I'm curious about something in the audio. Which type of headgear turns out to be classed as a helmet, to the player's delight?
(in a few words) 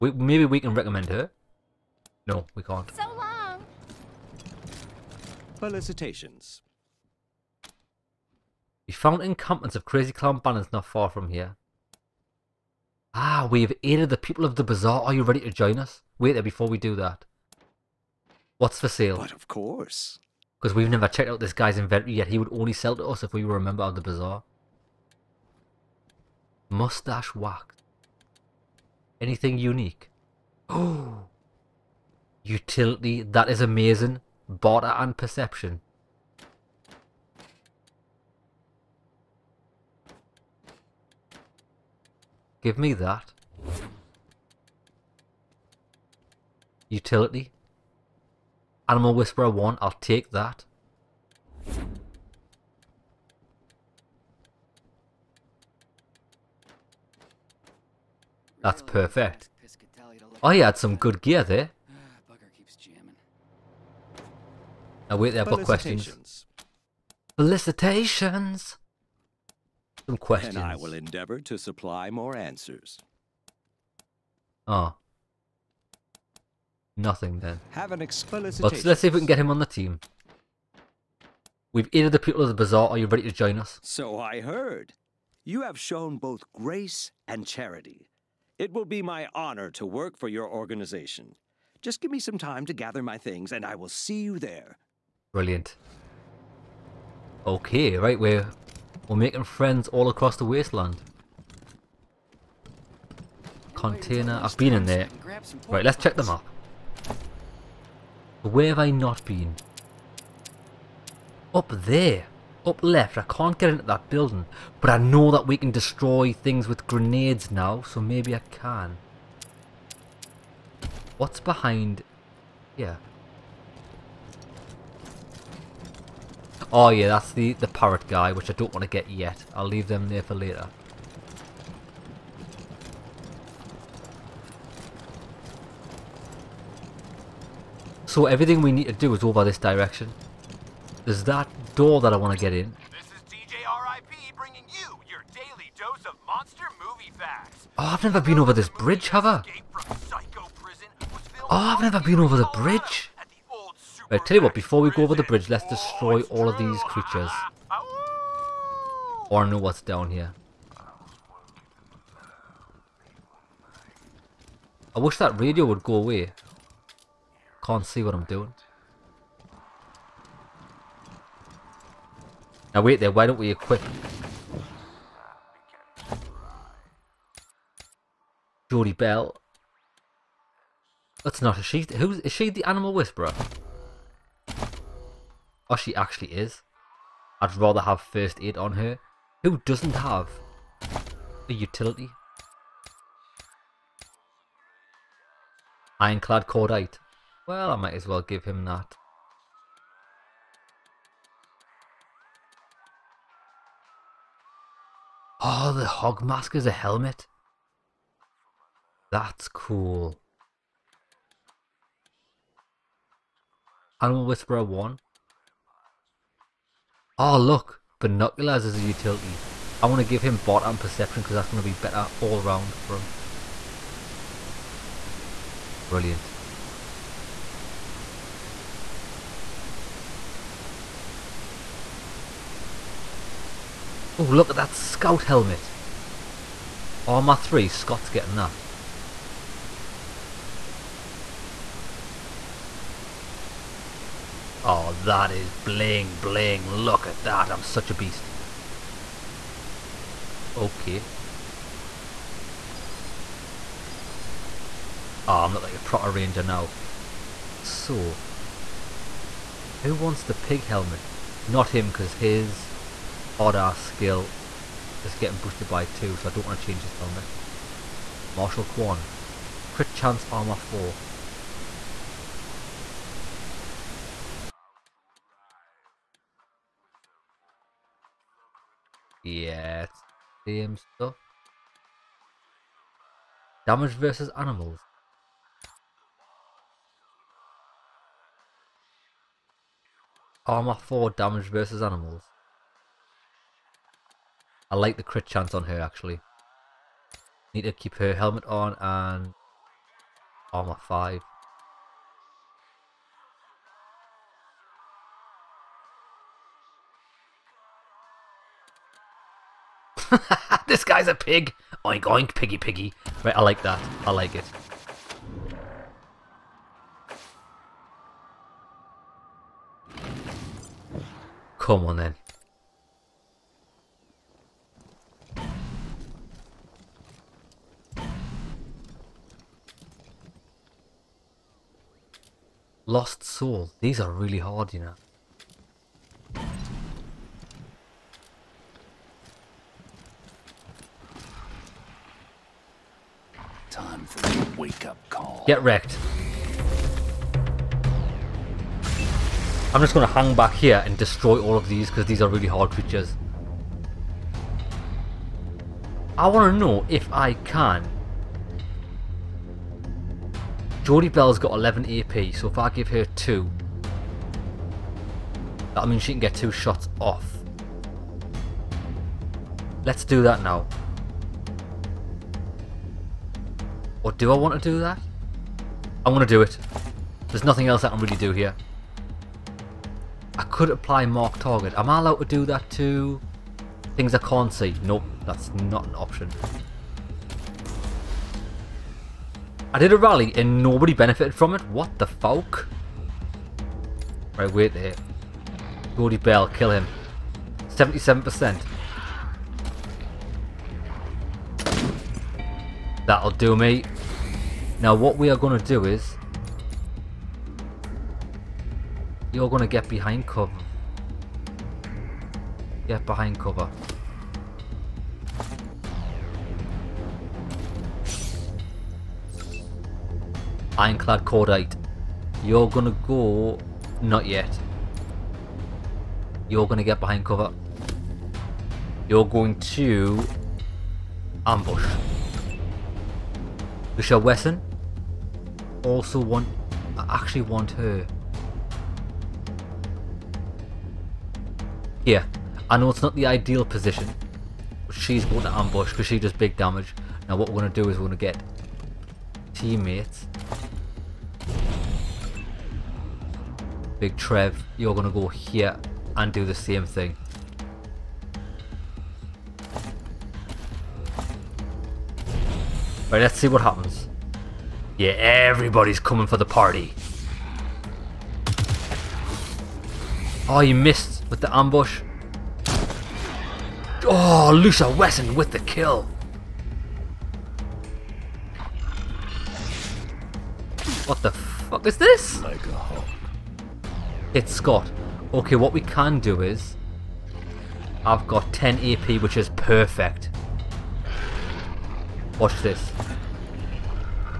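hog mask.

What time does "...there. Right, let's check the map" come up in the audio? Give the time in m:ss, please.
1:44.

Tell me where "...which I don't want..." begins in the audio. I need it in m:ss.
2:08.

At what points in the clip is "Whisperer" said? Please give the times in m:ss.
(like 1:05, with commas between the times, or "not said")
0:49, 3:02, 3:34.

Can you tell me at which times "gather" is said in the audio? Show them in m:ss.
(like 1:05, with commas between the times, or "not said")
1:32.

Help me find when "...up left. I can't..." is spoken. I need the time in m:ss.
1:52.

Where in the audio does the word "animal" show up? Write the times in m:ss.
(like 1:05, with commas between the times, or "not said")
0:48, 3:02, 3:34, 4:44, 4:51.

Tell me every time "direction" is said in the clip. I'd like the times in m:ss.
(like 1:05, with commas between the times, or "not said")
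2:19.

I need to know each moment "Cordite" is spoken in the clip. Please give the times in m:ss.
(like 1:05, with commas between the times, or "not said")
3:16, 7:01.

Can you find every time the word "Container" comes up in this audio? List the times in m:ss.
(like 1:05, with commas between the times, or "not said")
1:43.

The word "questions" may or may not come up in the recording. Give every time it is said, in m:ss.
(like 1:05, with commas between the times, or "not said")
1:05, 1:10.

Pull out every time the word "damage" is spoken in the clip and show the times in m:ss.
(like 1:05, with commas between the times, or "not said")
4:43, 4:51, 7:26.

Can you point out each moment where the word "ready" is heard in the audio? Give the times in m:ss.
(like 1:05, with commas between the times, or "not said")
0:15, 1:23.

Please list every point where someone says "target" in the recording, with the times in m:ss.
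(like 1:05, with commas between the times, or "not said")
6:21.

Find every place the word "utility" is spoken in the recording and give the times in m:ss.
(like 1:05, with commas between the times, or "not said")
0:32, 0:46, 3:11, 3:38.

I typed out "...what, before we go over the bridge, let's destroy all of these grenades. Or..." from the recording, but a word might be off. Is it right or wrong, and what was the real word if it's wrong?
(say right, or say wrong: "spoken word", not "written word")
wrong: "creatures", not "grenades".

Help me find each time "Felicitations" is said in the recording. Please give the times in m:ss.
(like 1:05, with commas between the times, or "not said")
0:05, 1:07.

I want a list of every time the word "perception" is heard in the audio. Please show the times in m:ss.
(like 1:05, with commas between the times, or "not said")
0:35, 3:40.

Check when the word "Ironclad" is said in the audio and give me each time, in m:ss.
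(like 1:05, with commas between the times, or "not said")
3:15, 7:00.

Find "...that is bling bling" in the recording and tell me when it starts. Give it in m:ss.
4:04.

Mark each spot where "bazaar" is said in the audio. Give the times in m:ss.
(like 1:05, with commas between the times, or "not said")
0:14, 0:24, 1:22.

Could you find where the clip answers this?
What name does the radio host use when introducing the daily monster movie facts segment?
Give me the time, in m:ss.
2:23.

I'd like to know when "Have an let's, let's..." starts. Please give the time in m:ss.
1:17.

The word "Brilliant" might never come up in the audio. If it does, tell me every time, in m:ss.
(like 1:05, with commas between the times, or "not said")
1:35, 3:45.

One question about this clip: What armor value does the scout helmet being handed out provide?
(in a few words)
3.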